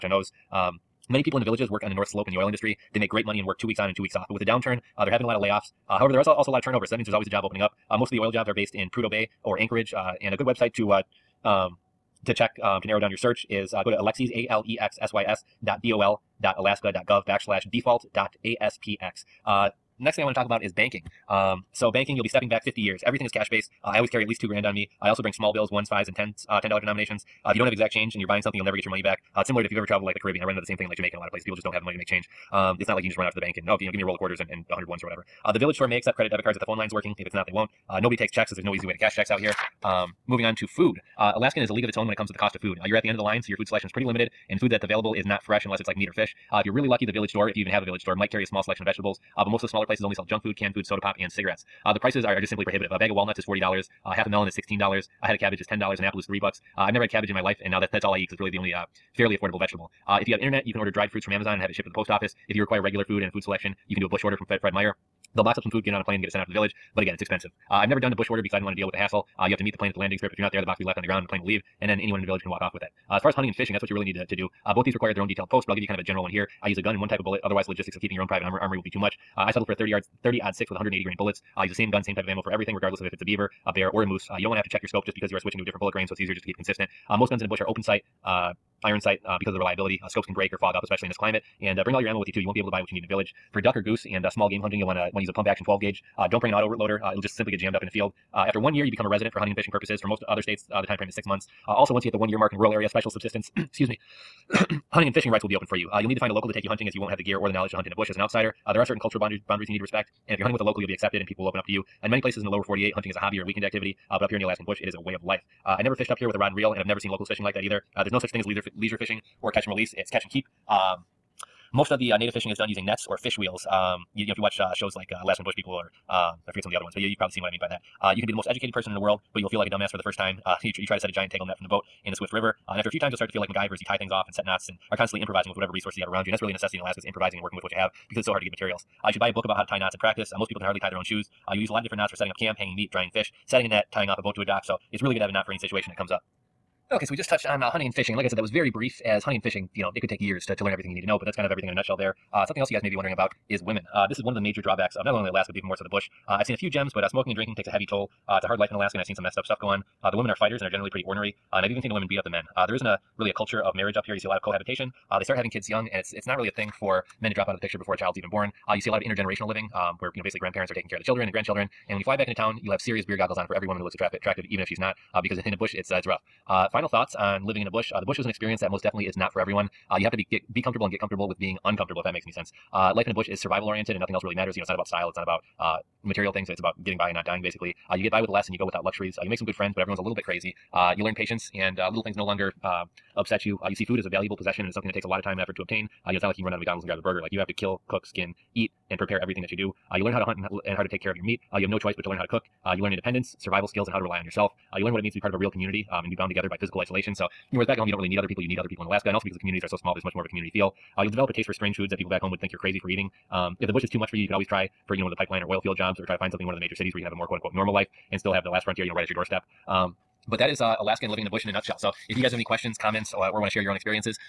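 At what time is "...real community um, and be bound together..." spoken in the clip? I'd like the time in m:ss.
3:25.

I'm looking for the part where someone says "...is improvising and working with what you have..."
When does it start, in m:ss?
2:16.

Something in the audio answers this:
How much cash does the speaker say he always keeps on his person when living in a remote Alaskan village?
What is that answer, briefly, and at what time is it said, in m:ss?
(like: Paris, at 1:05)
2000 dollars, at 0:24.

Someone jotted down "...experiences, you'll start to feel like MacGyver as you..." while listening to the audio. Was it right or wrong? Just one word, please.
wrong.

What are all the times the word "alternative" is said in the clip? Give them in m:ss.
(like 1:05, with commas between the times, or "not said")
not said.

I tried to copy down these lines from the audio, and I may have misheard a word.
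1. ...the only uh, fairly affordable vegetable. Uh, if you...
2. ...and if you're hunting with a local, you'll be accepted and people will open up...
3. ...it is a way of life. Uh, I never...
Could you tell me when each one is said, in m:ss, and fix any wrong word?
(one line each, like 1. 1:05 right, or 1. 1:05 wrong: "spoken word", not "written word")
1. 0:58 right
2. 1:50 right
3. 1:54 right.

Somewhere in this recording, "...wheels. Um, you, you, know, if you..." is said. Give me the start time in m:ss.
2:03.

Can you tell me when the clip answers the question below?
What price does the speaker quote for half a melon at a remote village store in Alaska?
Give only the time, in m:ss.
0:54.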